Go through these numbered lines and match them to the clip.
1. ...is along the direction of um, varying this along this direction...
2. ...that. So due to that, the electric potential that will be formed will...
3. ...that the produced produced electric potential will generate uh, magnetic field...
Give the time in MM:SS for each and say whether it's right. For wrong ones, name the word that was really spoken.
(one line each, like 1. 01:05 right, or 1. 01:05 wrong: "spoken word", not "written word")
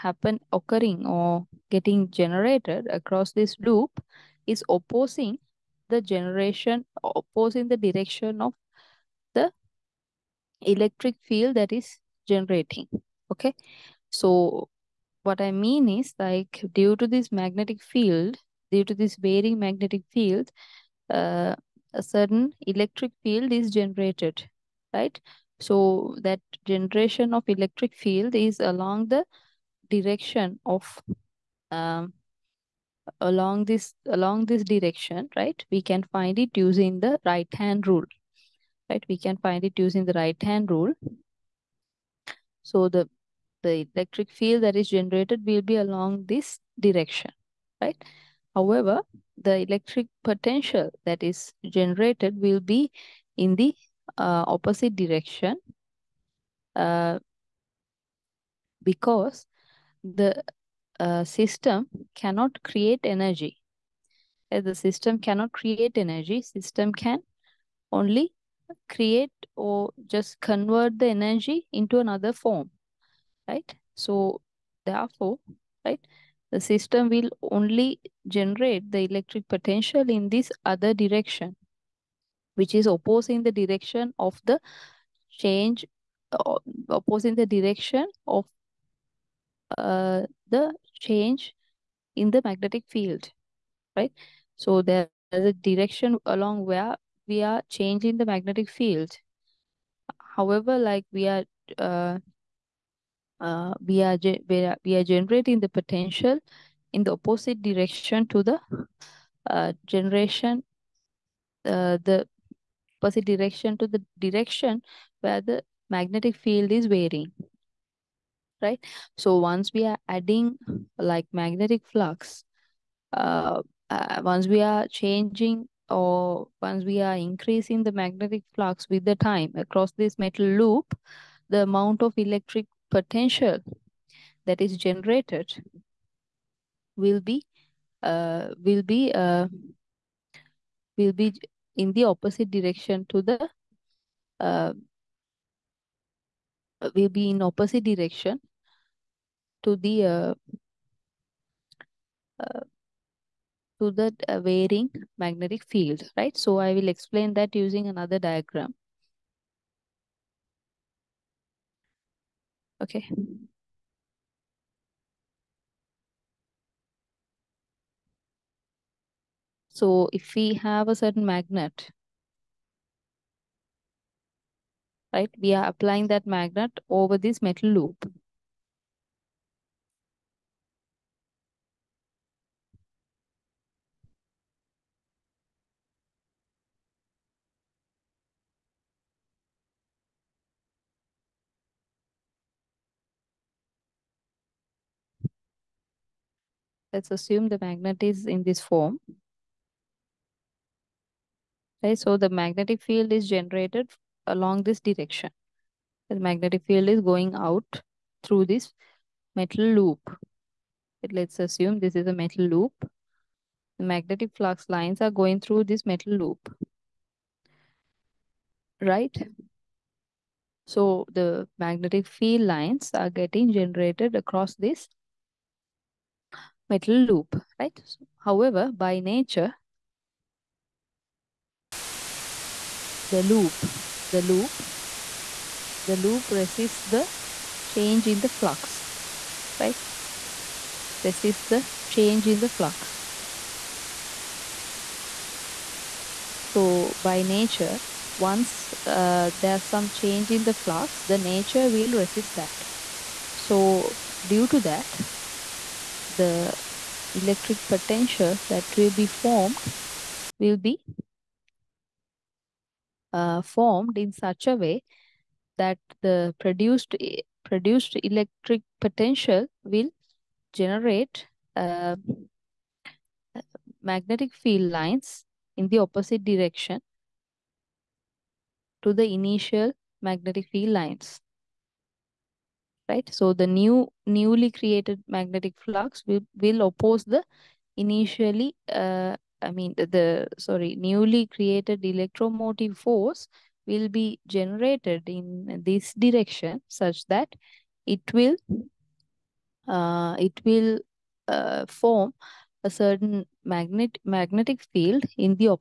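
1. 00:28 wrong: "along", not "varying"
2. 04:12 right
3. 04:25 right.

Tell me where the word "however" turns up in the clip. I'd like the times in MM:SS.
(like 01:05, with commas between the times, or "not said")
00:48, 01:40, 03:48.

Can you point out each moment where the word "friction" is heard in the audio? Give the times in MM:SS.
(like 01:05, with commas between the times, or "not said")
not said.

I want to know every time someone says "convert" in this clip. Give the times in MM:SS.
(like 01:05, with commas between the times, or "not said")
01:10.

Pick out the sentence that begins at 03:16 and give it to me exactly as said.
Let's assume the magnet is in this form.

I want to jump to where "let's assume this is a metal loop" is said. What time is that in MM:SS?
03:31.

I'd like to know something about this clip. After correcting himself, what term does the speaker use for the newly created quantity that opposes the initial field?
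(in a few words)
Electromotive force.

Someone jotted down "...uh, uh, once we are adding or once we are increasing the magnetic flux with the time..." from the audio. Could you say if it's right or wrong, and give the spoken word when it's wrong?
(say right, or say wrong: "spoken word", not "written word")
wrong: "changing", not "adding".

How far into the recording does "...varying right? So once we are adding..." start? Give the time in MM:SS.
01:56.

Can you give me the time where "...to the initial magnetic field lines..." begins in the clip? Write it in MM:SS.
04:38.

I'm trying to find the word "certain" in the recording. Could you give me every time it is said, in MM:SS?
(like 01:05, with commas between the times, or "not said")
00:22, 02:50, 05:02.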